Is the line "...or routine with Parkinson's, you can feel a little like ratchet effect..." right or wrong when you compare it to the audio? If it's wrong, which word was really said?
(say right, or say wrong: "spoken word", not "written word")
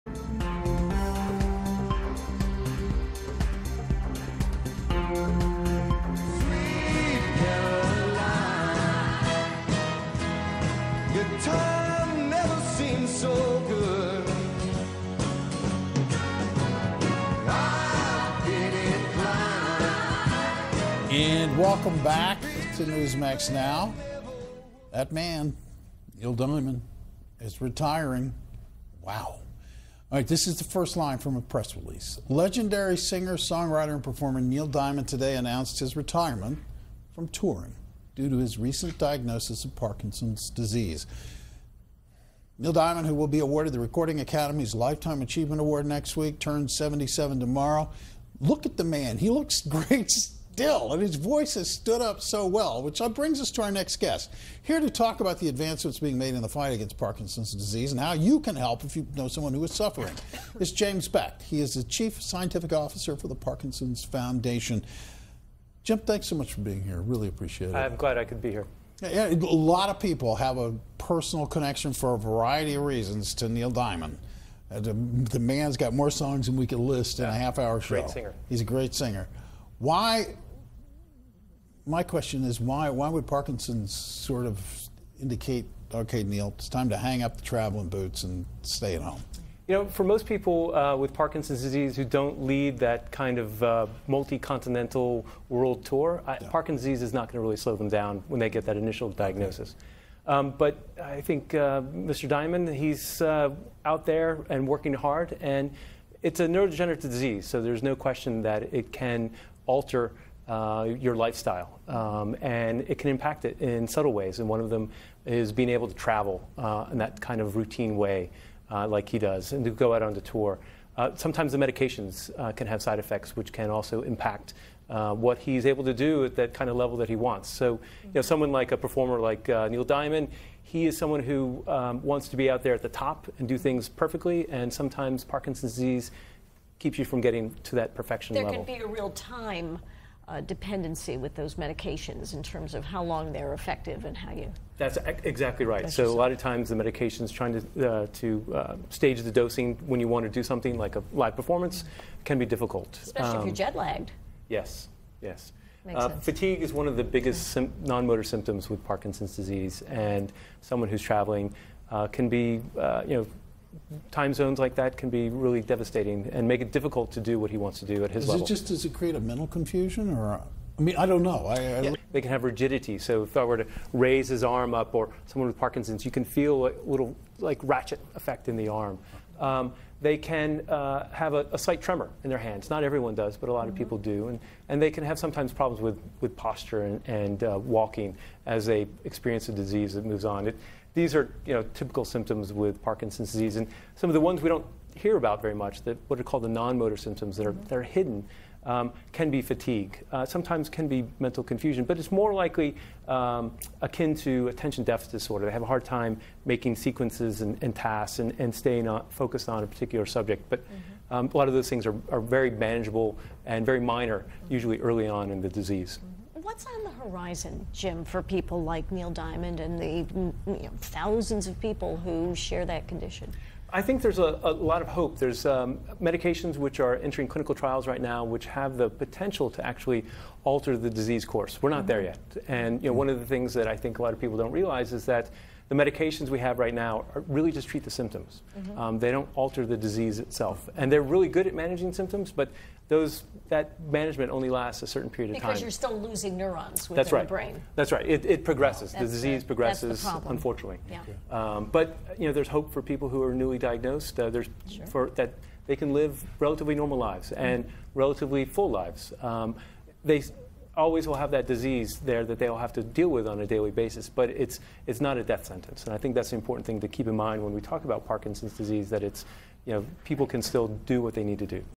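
wrong: "someone", not "routine".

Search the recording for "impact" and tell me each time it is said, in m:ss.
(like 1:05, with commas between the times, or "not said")
1:53, 2:04.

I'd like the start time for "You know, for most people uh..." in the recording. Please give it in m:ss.
1:29.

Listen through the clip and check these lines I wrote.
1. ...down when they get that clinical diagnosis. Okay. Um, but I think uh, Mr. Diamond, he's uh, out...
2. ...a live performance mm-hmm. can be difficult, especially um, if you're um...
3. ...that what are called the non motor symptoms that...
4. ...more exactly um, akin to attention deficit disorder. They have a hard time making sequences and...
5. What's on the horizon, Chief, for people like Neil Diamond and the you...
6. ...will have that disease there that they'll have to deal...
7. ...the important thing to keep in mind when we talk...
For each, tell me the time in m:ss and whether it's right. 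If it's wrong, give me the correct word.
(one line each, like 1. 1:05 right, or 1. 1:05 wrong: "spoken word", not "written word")
1. 1:37 wrong: "initial", not "clinical"
2. 2:30 right
3. 3:15 right
4. 3:22 wrong: "likely", not "exactly"
5. 3:36 wrong: "Jim", not "Chief"
6. 4:21 right
7. 4:26 right.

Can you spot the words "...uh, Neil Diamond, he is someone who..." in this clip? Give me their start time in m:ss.
2:09.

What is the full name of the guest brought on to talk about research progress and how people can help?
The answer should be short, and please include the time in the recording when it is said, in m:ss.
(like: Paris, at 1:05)
James Beck, at 1:00.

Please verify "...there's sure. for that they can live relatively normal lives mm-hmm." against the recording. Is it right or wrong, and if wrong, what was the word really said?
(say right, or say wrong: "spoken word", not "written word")
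right.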